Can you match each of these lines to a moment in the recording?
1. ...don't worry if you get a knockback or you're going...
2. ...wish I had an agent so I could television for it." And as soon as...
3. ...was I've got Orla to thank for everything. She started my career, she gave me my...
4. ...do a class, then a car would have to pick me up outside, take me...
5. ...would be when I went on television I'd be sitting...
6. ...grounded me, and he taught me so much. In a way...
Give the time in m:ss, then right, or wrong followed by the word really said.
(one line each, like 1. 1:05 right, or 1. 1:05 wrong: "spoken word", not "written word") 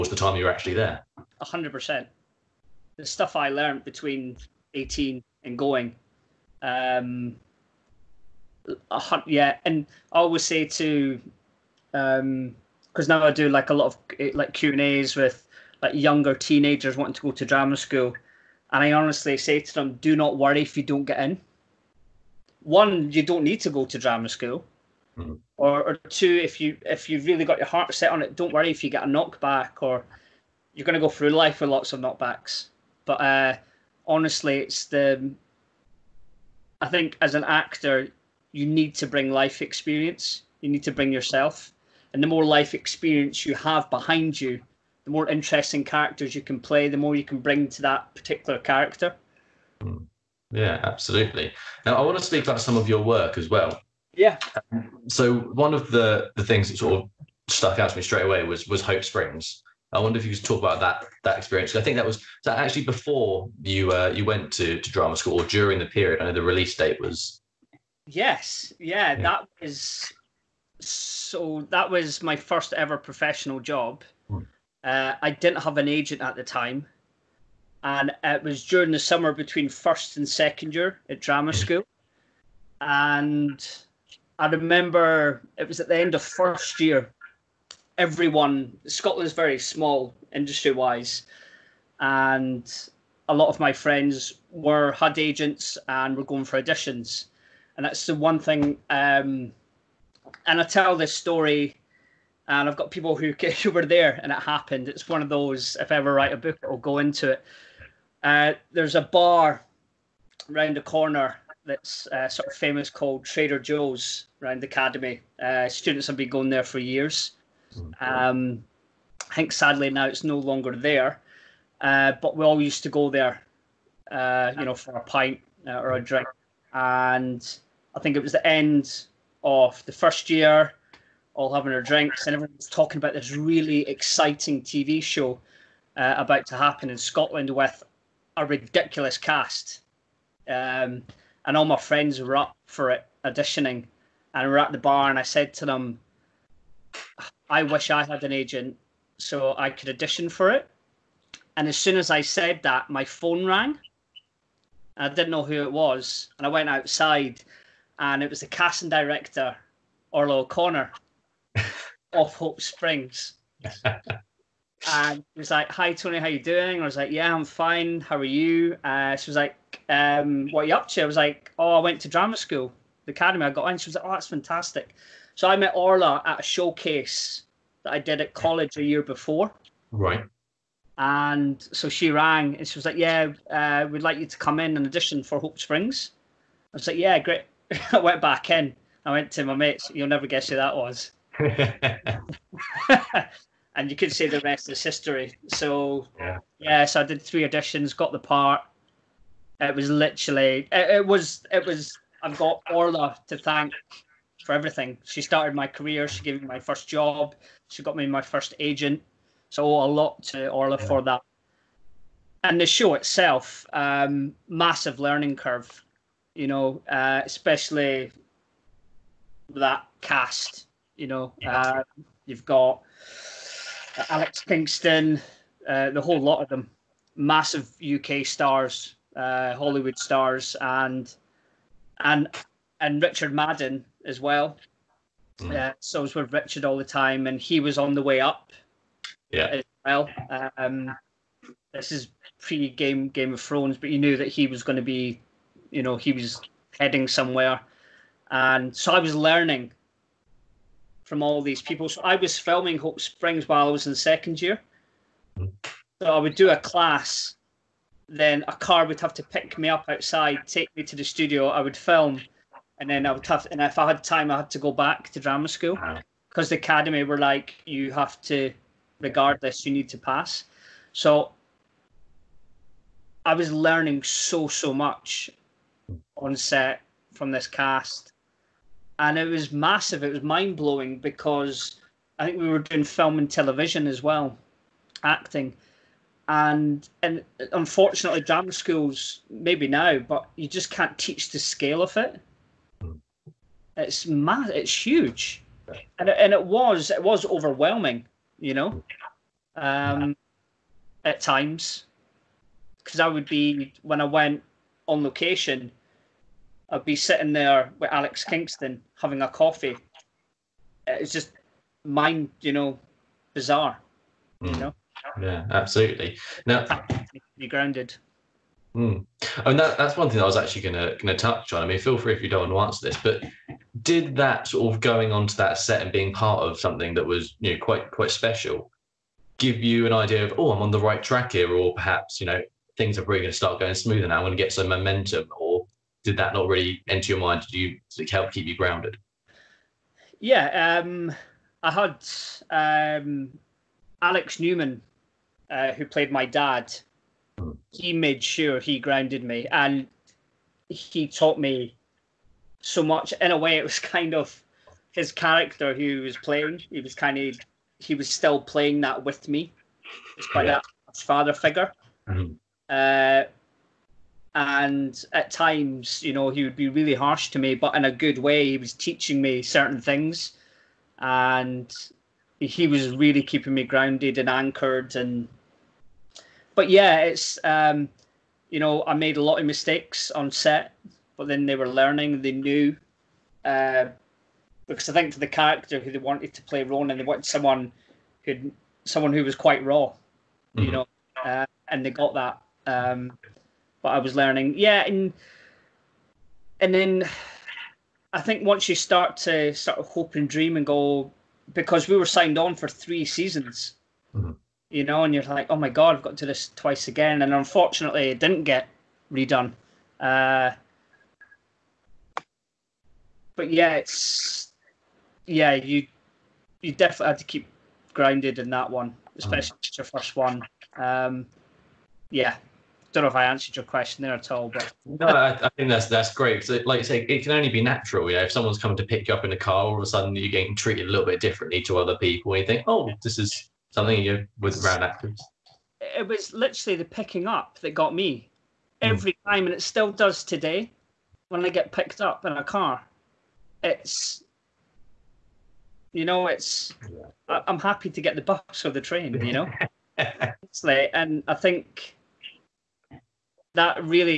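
1. 0:28 right
2. 2:27 wrong: "audition", not "television"
3. 3:21 right
4. 4:16 right
5. 5:03 wrong: "location", not "television"
6. 5:48 right.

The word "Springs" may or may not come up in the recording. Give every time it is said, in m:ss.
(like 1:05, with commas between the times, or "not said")
0:59, 2:42, 3:05, 4:12.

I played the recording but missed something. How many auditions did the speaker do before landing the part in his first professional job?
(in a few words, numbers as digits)
3.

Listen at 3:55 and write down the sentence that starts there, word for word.
Uh, so I was with Richard all the time, and he was on the way up.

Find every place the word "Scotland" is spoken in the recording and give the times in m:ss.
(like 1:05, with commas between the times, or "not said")
1:28, 2:16.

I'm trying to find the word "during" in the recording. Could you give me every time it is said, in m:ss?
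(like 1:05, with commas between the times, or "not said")
1:05, 1:18.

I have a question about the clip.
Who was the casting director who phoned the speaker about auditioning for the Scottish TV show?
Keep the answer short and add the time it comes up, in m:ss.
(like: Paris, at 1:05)
Orla O'Connor, at 2:40.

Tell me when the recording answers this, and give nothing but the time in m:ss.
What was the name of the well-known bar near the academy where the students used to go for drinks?
1:53.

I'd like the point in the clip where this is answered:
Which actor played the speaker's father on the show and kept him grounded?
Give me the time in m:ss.
5:44.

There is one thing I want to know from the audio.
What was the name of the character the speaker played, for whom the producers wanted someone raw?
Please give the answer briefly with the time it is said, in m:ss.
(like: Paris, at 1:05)
Ronan, at 6:26.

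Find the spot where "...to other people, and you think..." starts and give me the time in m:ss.
7:11.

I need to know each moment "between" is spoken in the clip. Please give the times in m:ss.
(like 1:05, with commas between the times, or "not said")
0:03, 1:19.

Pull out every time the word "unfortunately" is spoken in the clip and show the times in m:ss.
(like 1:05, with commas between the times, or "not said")
4:47, 6:47.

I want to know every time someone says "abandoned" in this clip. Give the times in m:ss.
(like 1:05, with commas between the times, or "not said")
not said.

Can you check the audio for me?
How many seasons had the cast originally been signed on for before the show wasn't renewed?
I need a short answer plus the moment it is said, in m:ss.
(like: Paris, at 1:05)
3, at 6:42.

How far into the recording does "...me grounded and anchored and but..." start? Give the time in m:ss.
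6:13.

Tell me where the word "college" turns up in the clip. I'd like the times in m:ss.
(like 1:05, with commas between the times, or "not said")
2:58.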